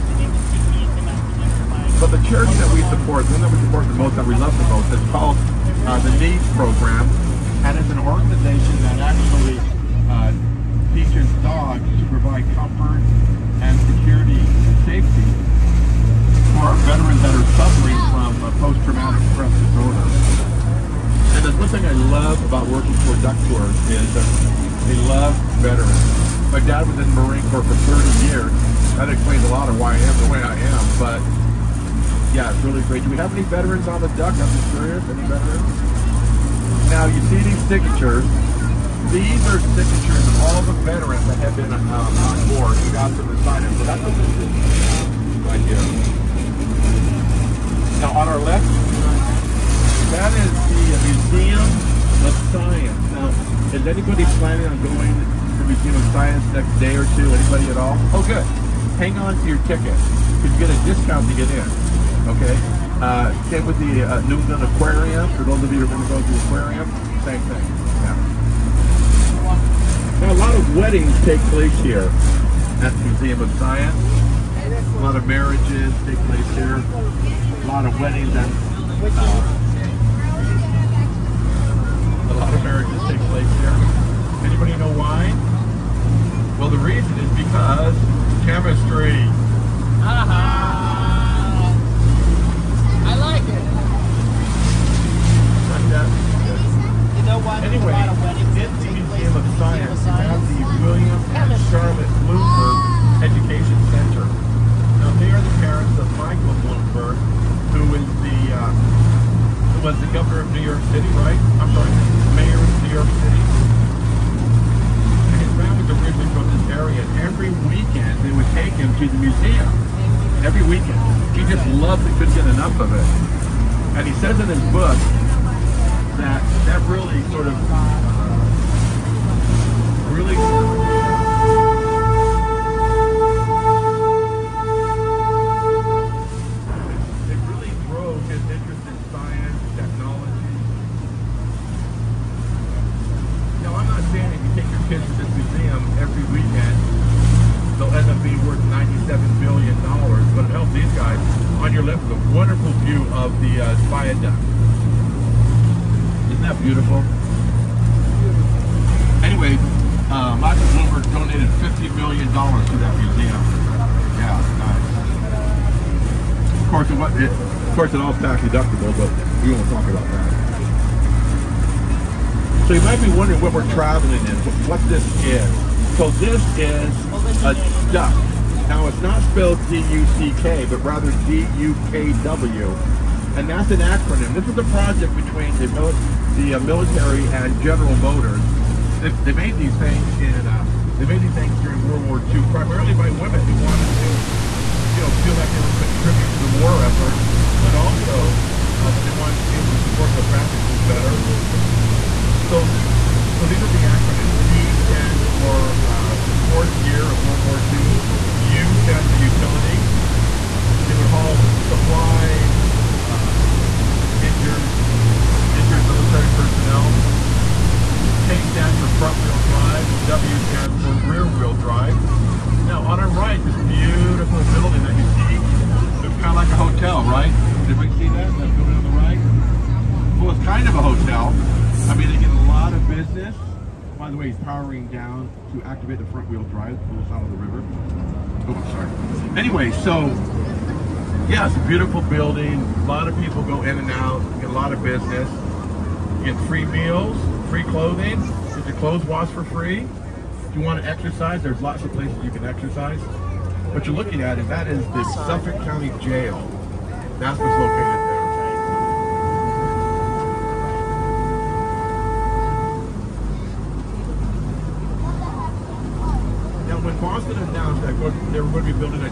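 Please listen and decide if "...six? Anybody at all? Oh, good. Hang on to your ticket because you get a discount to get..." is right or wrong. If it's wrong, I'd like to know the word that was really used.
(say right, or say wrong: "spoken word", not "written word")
wrong: "two", not "six".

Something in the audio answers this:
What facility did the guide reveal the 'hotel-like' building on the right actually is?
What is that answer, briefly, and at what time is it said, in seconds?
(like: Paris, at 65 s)
Suffolk County Jail, at 255 s.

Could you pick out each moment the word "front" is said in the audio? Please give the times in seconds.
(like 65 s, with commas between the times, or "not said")
218 s, 236 s.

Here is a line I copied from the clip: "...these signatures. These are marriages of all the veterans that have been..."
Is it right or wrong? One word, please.
wrong.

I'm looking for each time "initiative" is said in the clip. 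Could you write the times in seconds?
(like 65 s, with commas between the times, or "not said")
not said.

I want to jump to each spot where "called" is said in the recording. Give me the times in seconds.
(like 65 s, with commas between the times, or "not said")
5 s.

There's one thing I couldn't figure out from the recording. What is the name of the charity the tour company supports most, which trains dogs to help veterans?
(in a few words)
NEADS Program.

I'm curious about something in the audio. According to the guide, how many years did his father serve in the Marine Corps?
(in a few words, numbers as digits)
30.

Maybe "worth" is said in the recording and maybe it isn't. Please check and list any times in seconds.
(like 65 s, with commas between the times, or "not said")
148 s.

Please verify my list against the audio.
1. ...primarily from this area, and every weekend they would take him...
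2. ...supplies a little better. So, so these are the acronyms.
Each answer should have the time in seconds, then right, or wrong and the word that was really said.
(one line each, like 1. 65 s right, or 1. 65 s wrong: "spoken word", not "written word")
1. 115 s wrong: "originally", not "primarily"
2. 200 s wrong: "families", not "supplies".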